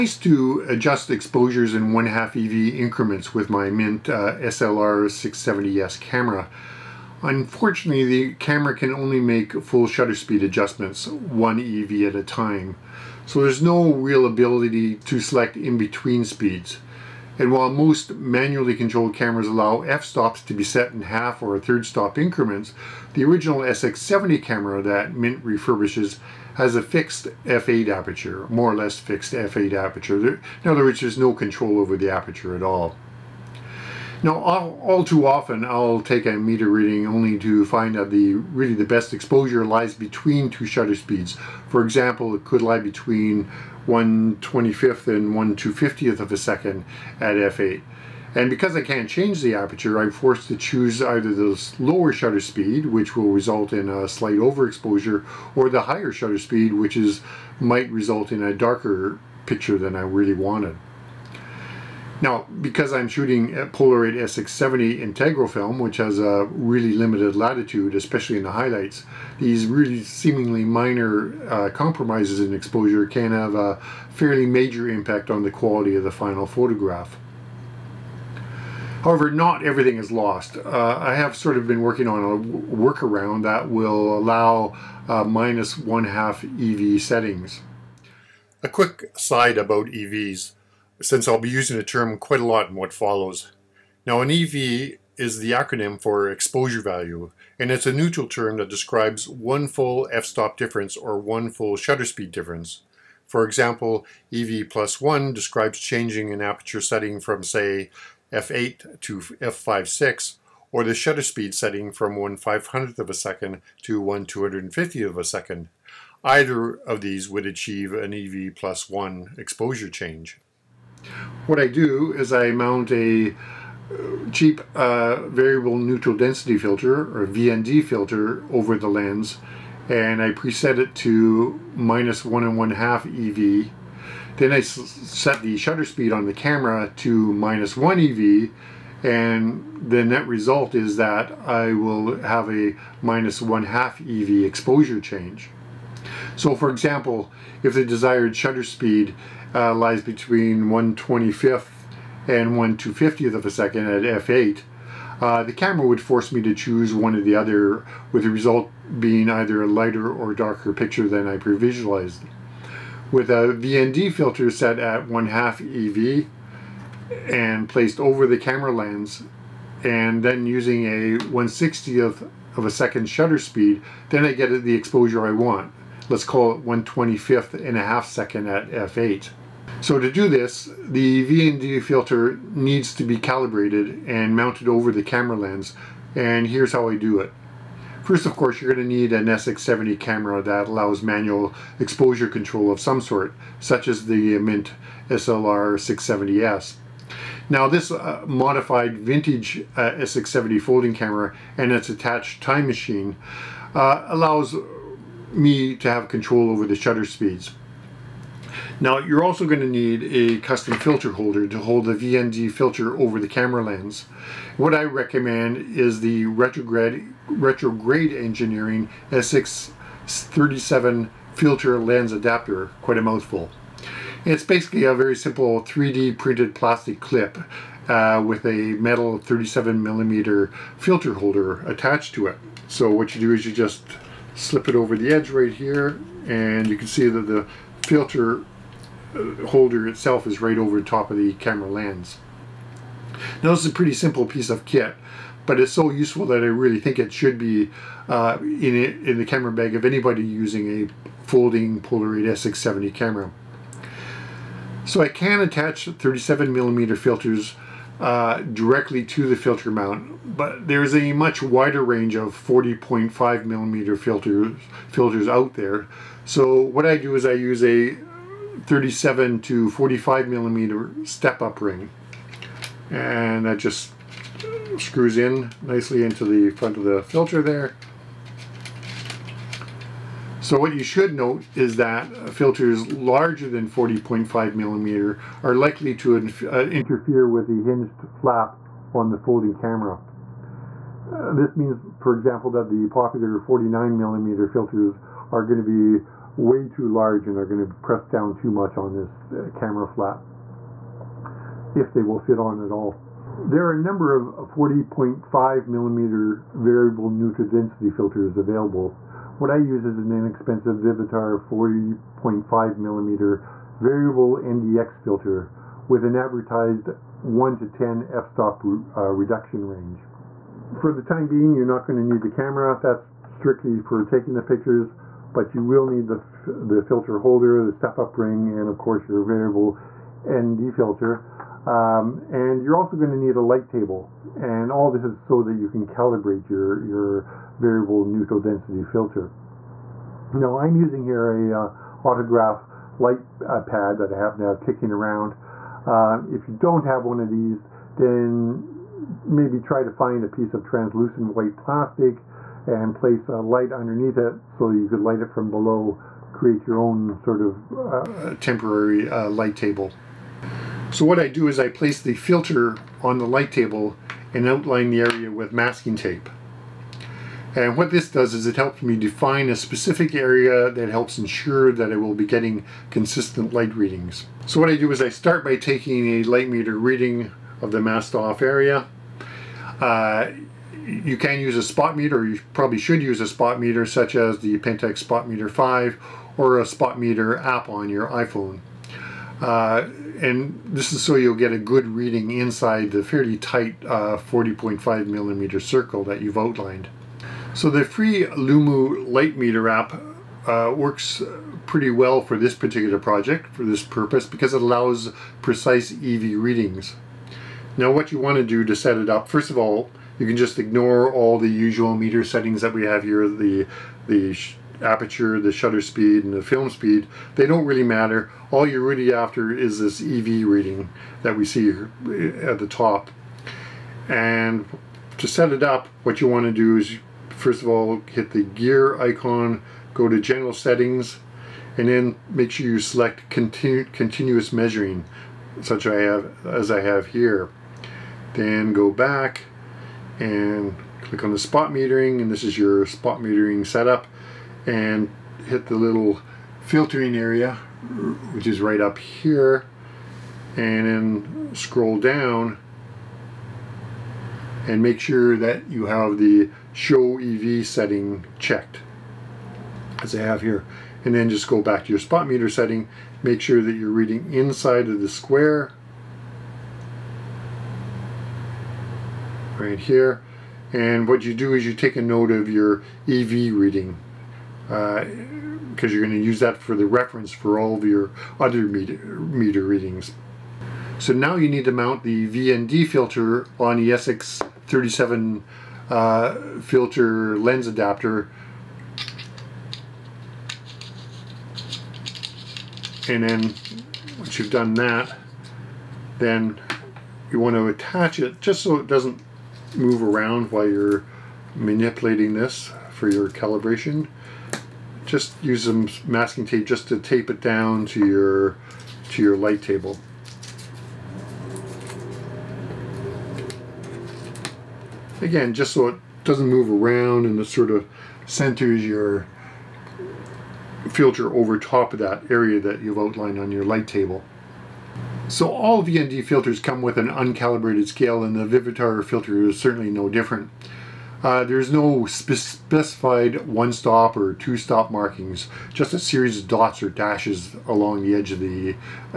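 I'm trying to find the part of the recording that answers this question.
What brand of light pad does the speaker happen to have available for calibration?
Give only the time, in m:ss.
5:42.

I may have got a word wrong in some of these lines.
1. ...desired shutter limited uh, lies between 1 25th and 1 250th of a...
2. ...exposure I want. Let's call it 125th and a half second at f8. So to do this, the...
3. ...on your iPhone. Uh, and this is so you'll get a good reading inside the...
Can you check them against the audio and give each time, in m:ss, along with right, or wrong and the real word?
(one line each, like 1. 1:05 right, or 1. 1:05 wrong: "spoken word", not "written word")
1. 2:27 wrong: "speed", not "limited"
2. 2:54 right
3. 6:27 right.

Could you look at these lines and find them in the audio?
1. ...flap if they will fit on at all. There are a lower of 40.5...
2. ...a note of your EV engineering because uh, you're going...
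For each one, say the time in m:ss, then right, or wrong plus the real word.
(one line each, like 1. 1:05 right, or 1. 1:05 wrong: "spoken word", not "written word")
1. 4:59 wrong: "number", not "lower"
2. 7:51 wrong: "reading", not "engineering".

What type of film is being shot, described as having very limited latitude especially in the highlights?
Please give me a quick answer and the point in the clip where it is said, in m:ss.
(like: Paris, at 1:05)
Polaroid SX70 integral film, at 1:03.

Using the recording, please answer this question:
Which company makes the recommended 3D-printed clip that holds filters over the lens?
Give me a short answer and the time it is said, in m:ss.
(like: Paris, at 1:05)
Retrograde Engineering, at 3:37.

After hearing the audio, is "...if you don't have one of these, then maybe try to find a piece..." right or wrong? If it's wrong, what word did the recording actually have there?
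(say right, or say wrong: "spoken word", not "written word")
right.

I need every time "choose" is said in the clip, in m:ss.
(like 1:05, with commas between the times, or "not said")
0:50, 2:36.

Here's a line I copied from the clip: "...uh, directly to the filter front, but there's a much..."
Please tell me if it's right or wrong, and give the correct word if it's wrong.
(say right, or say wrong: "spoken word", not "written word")
wrong: "mount", not "front".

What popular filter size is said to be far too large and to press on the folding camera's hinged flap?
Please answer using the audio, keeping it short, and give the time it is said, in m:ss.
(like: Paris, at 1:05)
49mm, at 4:53.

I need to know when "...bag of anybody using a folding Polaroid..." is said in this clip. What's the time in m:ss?
4:09.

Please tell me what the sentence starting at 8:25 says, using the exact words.
Just use some masking tape just to tape it down to your to your light table.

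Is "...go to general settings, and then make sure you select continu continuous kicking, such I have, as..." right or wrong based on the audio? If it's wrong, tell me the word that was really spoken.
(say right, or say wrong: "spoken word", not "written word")
wrong: "measuring", not "kicking".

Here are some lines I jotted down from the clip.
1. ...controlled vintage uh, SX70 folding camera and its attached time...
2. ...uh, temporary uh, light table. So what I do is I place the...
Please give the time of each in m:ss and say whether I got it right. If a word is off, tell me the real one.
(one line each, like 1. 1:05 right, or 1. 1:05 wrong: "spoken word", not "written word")
1. 3:18 wrong: "modified", not "controlled"
2. 5:57 right.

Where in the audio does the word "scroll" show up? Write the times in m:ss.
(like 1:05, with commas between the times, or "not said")
7:31.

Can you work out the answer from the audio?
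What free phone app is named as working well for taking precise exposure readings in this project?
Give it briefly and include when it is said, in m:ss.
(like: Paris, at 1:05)
Lumu, at 6:38.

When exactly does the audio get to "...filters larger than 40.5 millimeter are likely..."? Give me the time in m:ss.
4:42.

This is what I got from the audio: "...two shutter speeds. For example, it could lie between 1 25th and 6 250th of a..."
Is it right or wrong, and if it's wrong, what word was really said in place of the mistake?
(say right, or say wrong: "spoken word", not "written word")
wrong: "1", not "6".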